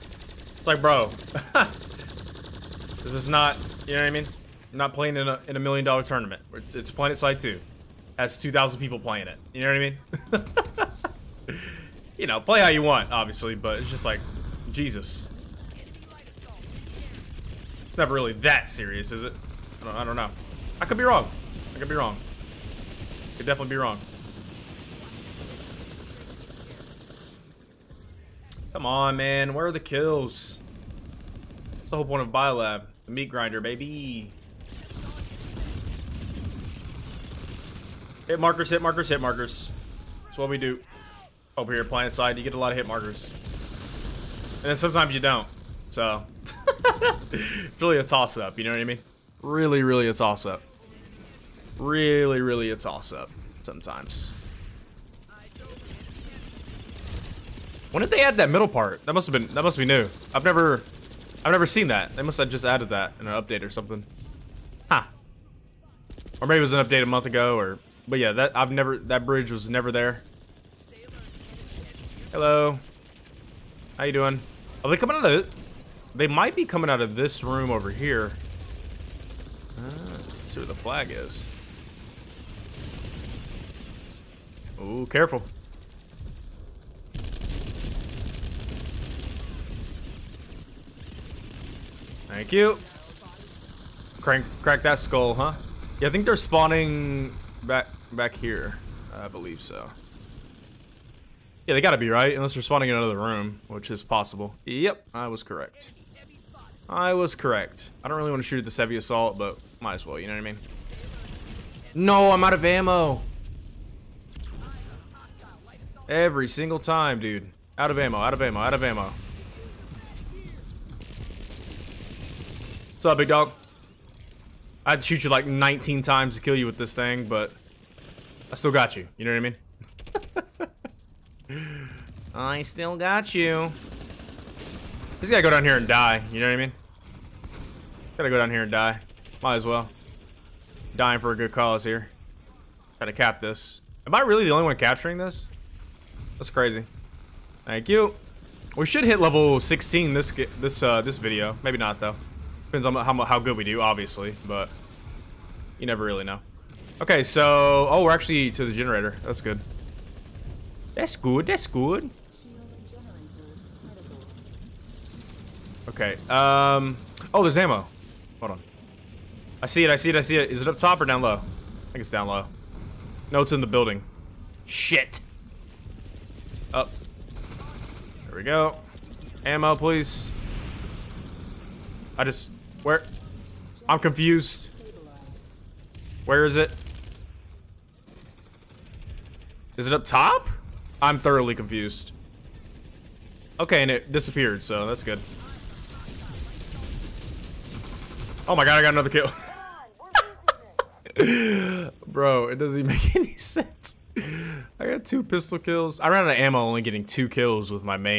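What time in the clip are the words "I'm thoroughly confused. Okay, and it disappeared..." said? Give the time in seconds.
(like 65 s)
191 s.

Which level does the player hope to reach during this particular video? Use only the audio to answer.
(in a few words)
16.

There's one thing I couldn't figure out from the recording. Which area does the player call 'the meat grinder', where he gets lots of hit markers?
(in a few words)
Biolab.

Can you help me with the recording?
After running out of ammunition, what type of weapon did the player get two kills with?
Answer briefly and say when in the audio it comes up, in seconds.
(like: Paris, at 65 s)
pistol, at 205 s.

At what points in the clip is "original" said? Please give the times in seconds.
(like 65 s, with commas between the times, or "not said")
not said.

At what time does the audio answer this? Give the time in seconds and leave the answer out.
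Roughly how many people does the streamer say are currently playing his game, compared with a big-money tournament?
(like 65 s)
8 s.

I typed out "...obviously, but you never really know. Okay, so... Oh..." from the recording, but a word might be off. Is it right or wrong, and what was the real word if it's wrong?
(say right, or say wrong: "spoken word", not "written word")
right.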